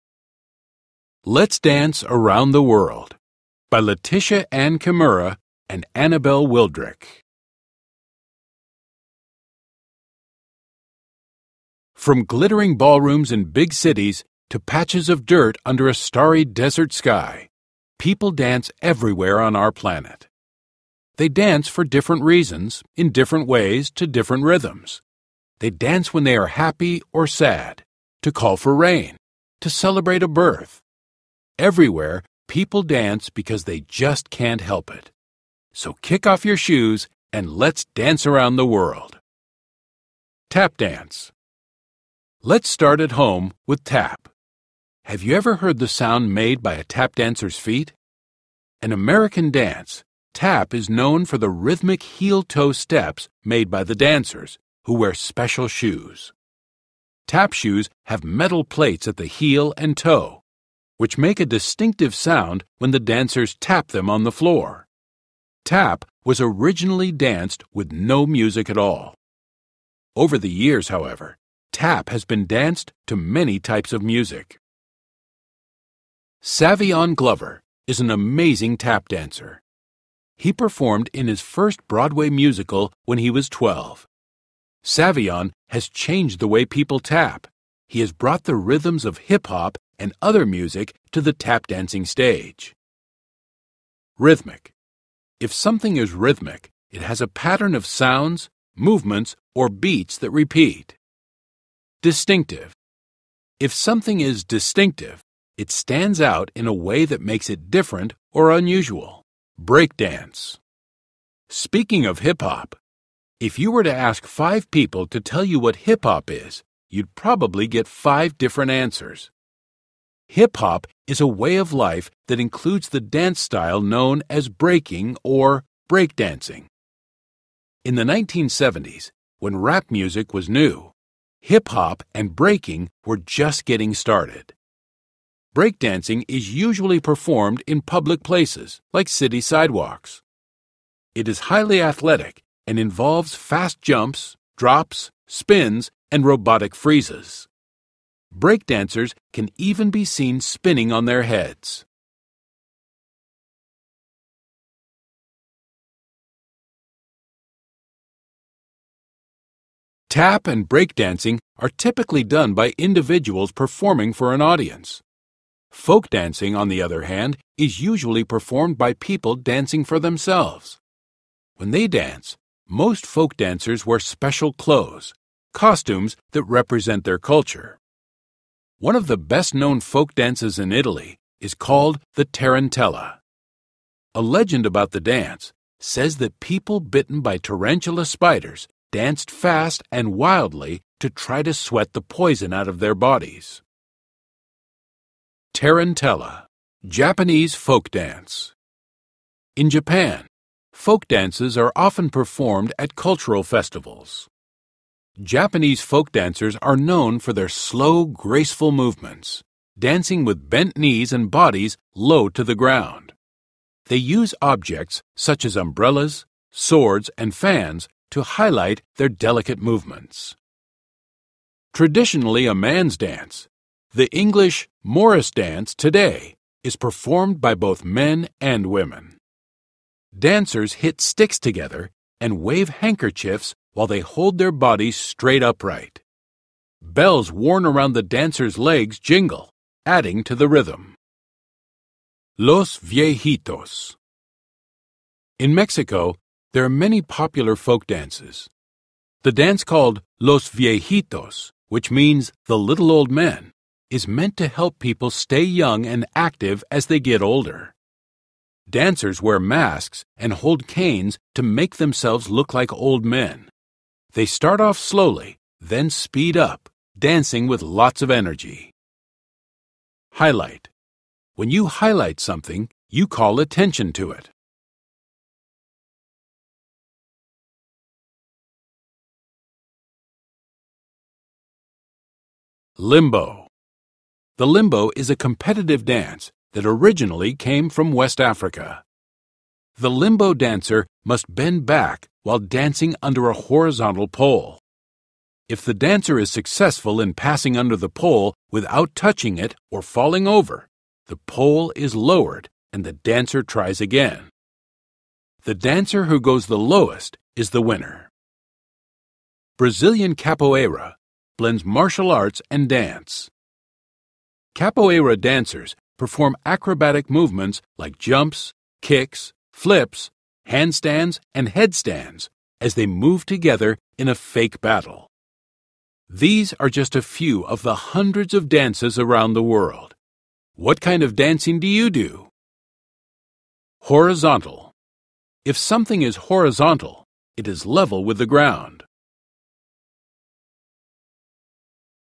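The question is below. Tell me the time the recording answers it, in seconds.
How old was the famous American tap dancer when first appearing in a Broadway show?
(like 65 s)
83 s.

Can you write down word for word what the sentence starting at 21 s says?
They dance for different reasons, in different ways, to different rhythms.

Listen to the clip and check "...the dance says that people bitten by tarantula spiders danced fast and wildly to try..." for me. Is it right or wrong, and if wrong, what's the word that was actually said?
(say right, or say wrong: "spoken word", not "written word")
right.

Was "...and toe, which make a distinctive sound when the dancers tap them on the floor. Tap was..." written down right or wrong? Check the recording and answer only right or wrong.
right.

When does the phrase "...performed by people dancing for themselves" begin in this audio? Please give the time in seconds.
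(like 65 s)
168 s.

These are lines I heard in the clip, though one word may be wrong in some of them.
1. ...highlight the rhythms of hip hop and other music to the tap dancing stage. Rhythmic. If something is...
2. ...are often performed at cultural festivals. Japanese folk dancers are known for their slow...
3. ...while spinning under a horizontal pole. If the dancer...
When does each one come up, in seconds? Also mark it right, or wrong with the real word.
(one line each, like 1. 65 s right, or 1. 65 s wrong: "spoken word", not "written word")
1. 88 s wrong: "brought", not "highlight"
2. 201 s right
3. 292 s wrong: "dancing", not "spinning".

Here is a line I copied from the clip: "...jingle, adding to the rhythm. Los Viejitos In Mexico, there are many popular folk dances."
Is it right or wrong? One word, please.
right.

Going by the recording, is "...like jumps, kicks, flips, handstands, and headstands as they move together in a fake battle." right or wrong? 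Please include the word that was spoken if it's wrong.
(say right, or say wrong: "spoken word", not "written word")
right.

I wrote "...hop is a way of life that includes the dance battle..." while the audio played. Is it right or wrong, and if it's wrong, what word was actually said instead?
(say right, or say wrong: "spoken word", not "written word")
wrong: "style", not "battle".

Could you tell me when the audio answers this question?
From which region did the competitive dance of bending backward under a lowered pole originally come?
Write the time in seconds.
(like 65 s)
287 s.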